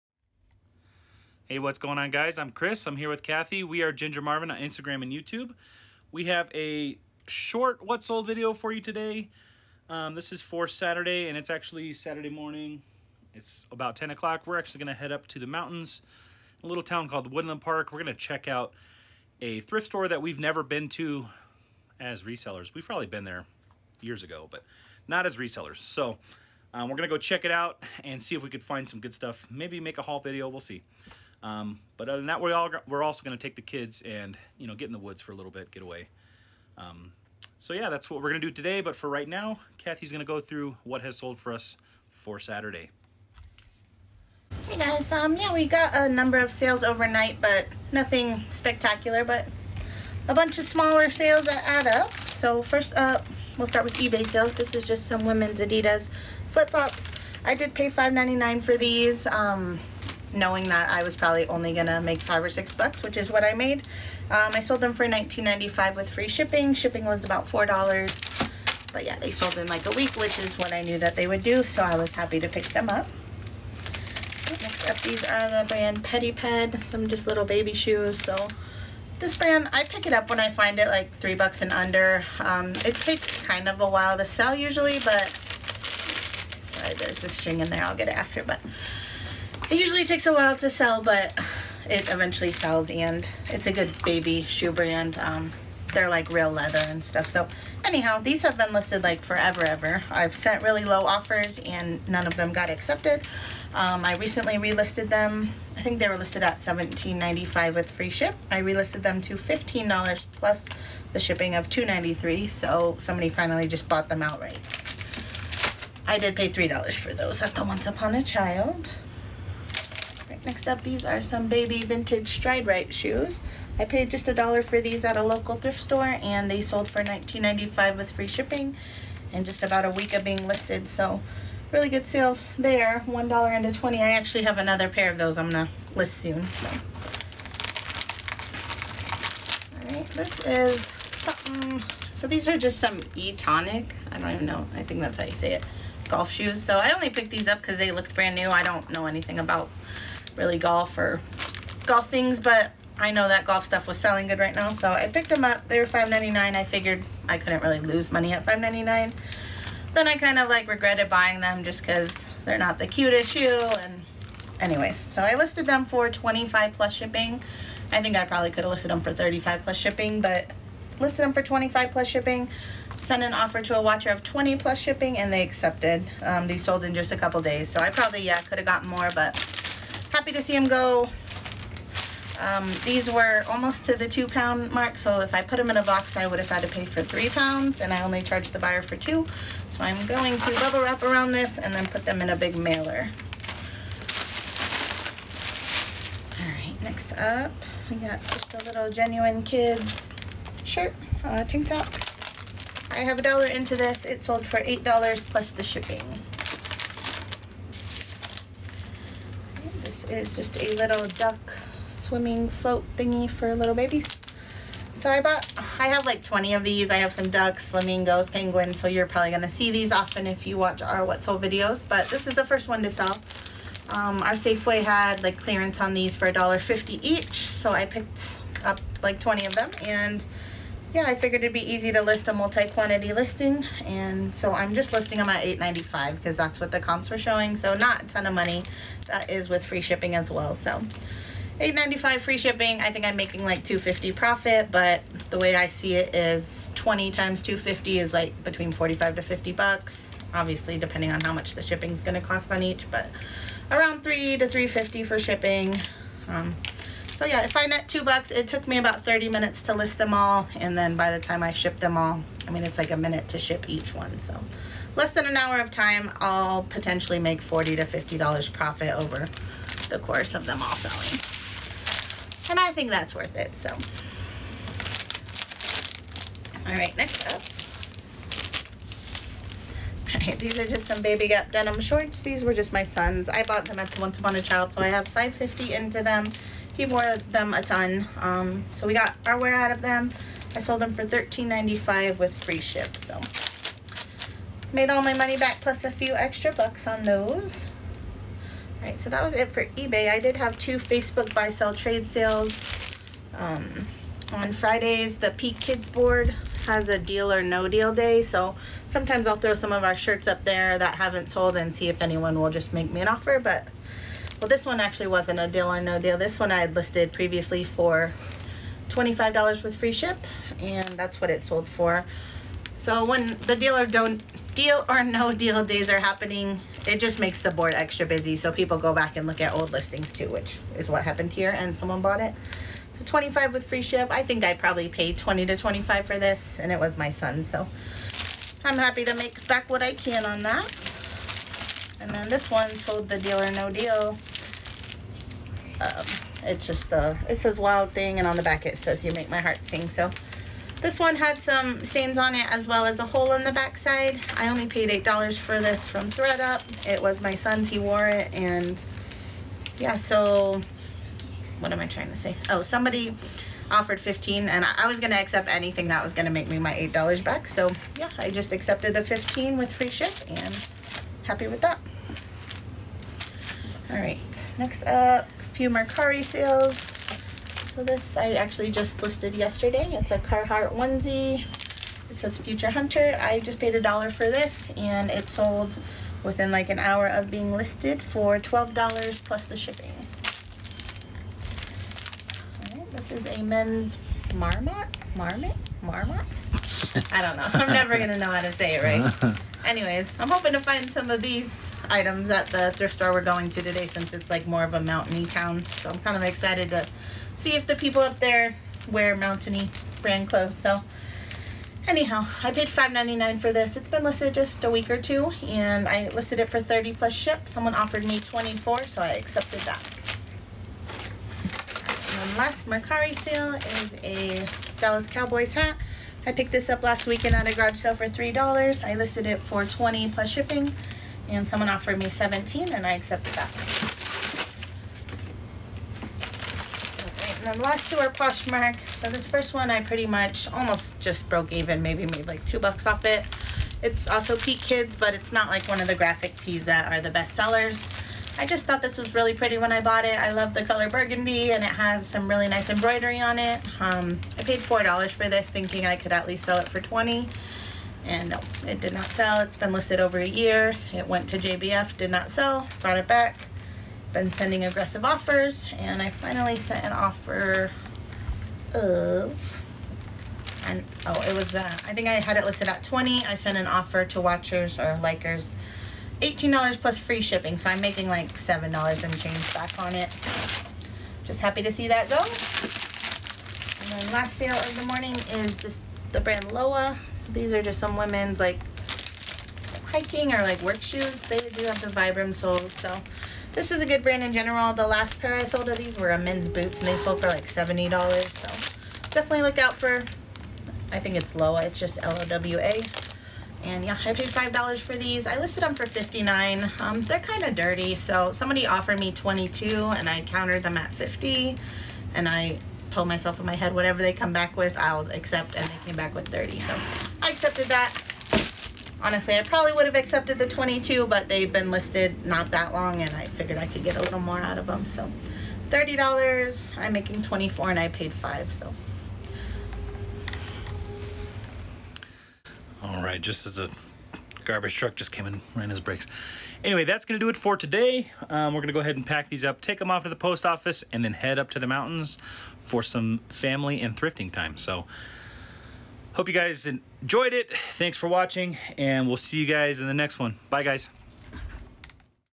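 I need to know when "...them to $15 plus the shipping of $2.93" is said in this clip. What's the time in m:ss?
1:49.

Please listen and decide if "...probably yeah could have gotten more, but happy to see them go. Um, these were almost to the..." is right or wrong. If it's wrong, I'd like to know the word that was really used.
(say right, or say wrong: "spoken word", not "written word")
right.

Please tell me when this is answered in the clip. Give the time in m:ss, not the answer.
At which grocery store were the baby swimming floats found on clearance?
3:44.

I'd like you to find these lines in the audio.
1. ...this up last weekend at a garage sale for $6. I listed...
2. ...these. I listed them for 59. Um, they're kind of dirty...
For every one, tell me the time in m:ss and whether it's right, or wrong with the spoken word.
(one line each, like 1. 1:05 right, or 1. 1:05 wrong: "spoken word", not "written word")
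1. 7:06 wrong: "3", not "6"
2. 8:24 right.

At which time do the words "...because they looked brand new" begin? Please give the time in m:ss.
2:27.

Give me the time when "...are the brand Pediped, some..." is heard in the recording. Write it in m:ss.
1:15.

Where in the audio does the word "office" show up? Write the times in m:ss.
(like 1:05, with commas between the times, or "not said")
9:00.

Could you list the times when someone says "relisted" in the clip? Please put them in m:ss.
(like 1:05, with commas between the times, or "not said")
1:44, 1:48.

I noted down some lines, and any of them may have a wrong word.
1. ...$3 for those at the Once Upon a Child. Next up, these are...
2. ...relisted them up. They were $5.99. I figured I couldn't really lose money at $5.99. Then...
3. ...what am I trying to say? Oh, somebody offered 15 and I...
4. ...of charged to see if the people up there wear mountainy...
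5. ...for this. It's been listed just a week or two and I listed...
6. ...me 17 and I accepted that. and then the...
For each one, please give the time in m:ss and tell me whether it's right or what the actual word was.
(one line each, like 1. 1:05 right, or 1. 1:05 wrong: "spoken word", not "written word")
1. 1:56 right
2. 2:35 wrong: "picked", not "relisted"
3. 6:01 right
4. 6:46 wrong: "excited", not "charged"
5. 6:53 right
6. 7:11 right.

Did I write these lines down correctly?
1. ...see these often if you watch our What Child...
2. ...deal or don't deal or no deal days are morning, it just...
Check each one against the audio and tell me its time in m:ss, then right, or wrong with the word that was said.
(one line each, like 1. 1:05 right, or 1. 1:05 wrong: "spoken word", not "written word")
1. 3:39 wrong: "Sold", not "Child"
2. 5:23 wrong: "happening", not "morning".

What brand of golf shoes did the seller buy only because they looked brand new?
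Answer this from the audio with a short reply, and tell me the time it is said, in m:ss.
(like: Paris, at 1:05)
Etonic, at 2:23.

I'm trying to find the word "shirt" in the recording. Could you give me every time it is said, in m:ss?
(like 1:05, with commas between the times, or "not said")
3:20, 5:09.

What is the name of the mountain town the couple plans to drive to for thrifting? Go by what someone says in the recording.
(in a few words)
Woodland Park.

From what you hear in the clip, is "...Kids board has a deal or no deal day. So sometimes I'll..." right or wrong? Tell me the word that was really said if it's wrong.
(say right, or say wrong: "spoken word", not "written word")
right.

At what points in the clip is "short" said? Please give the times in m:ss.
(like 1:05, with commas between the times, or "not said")
0:07, 4:41.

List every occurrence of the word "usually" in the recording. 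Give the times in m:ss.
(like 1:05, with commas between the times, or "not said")
1:24, 1:29.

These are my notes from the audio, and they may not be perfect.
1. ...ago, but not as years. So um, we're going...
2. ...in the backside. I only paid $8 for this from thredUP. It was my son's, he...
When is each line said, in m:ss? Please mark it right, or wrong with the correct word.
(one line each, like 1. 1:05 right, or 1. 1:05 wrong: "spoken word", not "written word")
1. 0:24 wrong: "resellers", not "years"
2. 5:53 right.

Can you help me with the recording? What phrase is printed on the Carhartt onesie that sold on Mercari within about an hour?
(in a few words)
Future Hunter.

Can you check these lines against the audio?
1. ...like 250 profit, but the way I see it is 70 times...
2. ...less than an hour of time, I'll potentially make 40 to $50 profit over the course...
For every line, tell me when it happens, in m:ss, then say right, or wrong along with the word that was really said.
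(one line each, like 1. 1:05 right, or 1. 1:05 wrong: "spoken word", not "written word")
1. 4:03 wrong: "20", not "70"
2. 4:24 right.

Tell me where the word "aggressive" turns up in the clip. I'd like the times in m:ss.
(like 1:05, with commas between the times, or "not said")
7:44.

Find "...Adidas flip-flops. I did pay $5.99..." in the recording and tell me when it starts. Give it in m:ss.
0:55.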